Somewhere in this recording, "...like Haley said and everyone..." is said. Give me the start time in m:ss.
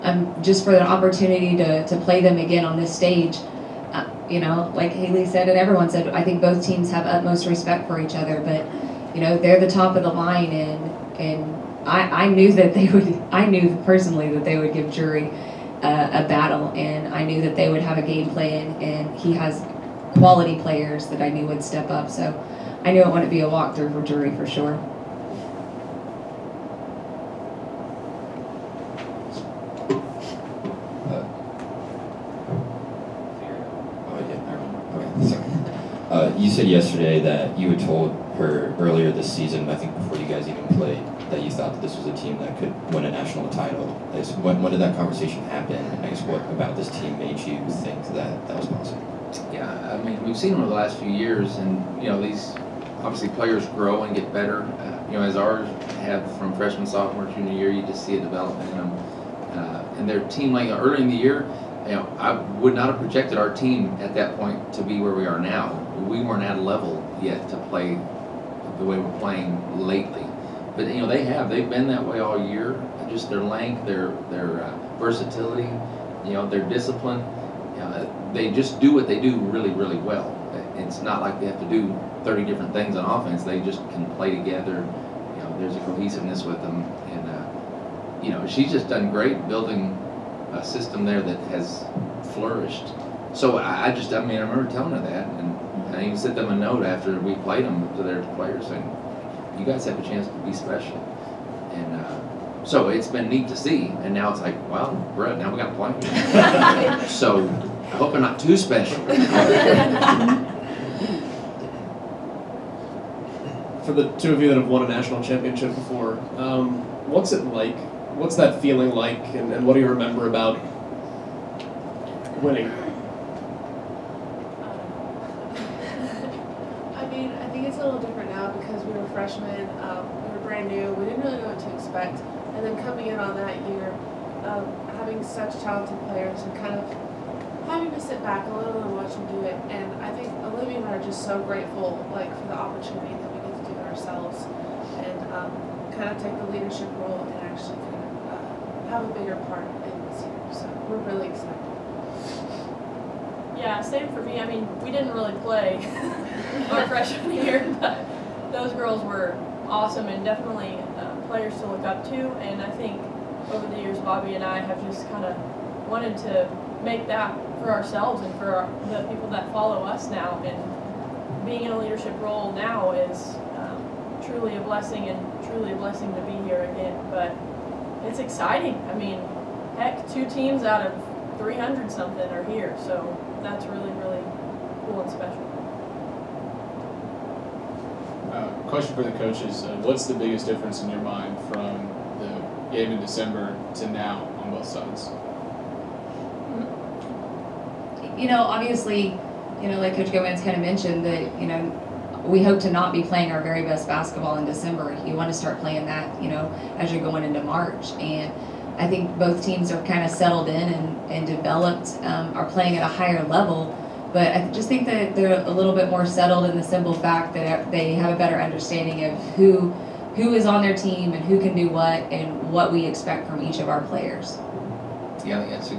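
0:04.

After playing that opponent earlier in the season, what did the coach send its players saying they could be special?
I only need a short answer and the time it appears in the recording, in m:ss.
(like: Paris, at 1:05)
A note, at 1:36.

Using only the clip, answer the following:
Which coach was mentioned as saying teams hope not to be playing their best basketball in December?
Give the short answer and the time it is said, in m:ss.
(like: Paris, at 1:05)
Coach Gomez, at 3:19.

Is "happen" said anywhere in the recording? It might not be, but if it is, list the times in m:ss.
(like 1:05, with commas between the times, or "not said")
0:45.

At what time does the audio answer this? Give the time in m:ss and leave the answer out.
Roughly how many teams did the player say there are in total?
3:01.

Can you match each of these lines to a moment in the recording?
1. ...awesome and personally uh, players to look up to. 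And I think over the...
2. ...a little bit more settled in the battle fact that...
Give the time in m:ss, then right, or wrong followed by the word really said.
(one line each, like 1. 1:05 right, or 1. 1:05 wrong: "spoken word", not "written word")
1. 2:39 wrong: "definitely", not "personally"
2. 3:35 wrong: "simple", not "battle".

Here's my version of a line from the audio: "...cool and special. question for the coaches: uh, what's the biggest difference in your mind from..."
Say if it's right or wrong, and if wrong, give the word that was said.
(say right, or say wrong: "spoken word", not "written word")
right.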